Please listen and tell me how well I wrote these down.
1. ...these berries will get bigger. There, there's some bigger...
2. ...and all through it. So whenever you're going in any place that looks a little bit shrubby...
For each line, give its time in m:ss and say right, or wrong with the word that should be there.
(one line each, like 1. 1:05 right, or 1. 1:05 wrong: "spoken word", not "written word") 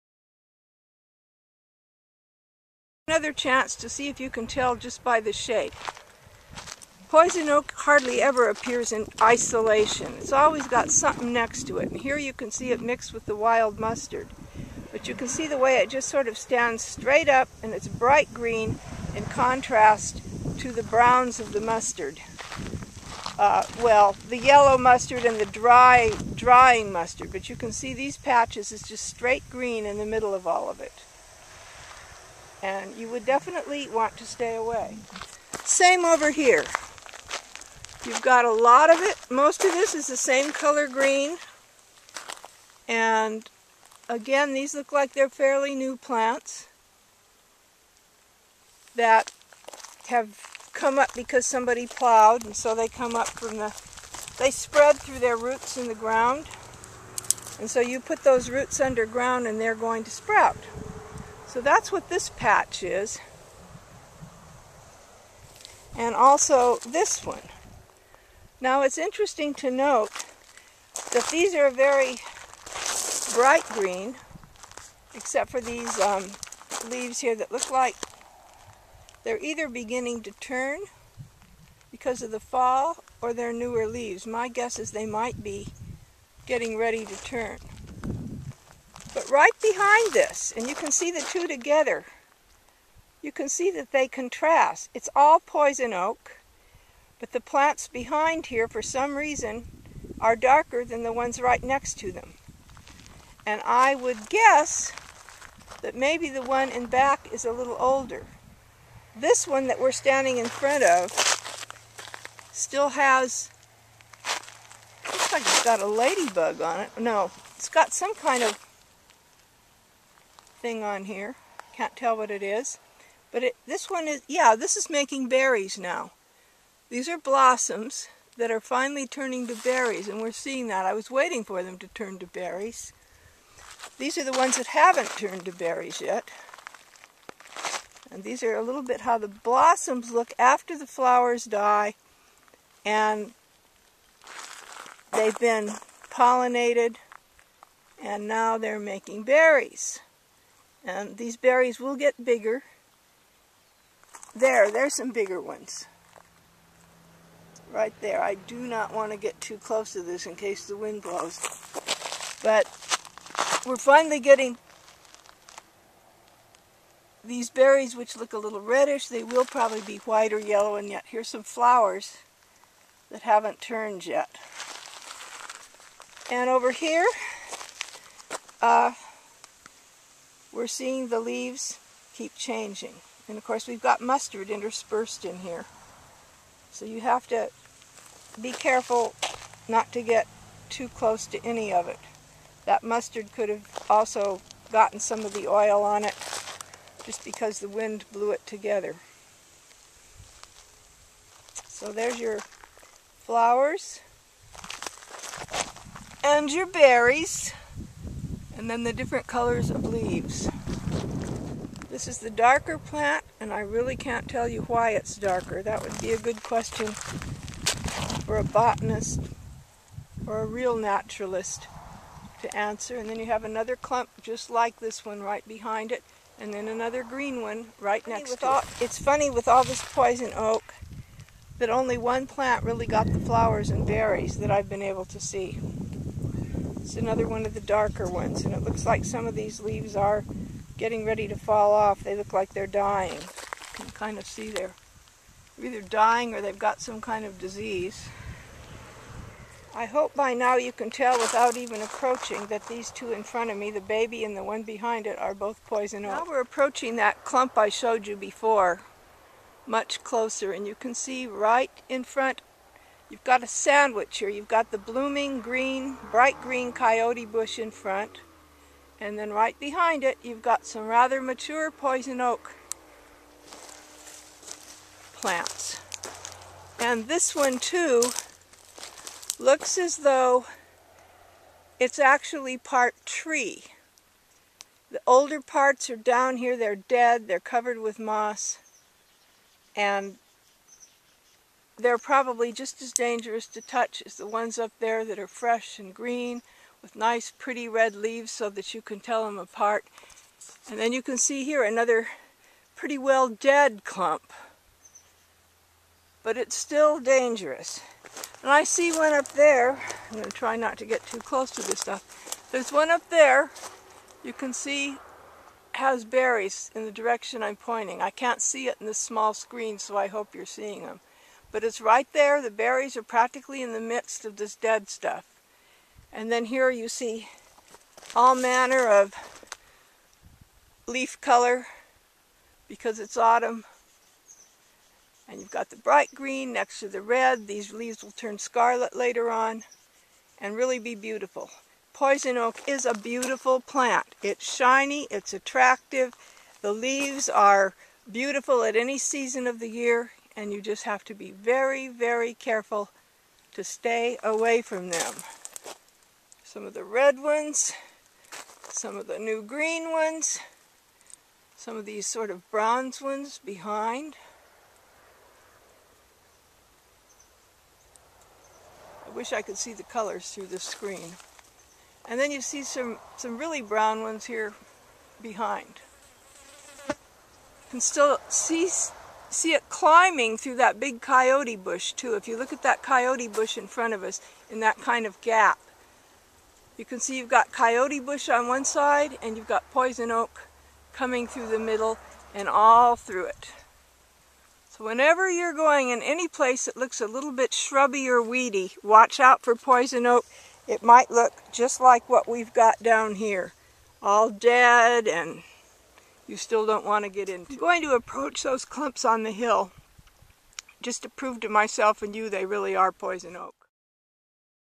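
1. 2:31 right
2. 6:32 right.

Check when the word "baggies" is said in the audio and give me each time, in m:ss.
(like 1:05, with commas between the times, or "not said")
not said.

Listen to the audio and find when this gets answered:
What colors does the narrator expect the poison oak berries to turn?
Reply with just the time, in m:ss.
2:49.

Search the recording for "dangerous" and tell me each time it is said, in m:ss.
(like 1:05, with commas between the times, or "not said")
4:52, 5:06.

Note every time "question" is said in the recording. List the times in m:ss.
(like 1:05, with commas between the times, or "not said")
3:36.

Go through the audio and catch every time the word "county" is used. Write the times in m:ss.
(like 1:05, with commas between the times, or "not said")
not said.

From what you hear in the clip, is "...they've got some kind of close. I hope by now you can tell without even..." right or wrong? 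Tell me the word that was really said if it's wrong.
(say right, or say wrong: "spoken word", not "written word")
wrong: "disease", not "close".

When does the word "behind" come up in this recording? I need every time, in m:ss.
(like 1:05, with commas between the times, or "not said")
1:29, 1:37, 3:45, 4:14, 4:29, 6:03, 6:15.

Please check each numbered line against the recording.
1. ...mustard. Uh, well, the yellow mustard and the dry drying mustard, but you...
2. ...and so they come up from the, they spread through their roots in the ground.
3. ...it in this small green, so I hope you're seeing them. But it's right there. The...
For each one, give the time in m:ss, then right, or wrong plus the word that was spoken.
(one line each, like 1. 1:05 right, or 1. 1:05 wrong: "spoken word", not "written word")
1. 0:21 right
2. 0:52 right
3. 5:18 wrong: "screen", not "green".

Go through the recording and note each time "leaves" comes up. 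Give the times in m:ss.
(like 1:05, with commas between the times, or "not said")
1:16, 1:23, 3:01, 3:29, 3:59, 4:57, 5:37, 5:46.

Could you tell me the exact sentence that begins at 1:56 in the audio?
No, it's got some kind of thing on here.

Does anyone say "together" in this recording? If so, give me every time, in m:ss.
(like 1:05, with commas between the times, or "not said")
1:31, 3:18.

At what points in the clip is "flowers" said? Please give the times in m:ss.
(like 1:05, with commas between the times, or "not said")
2:20, 2:51, 3:23, 3:53.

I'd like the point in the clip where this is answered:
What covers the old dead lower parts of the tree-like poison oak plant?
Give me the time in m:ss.
4:47.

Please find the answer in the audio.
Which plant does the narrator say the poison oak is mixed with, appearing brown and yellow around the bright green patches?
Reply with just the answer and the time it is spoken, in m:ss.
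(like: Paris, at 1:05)
wild mustard, at 0:13.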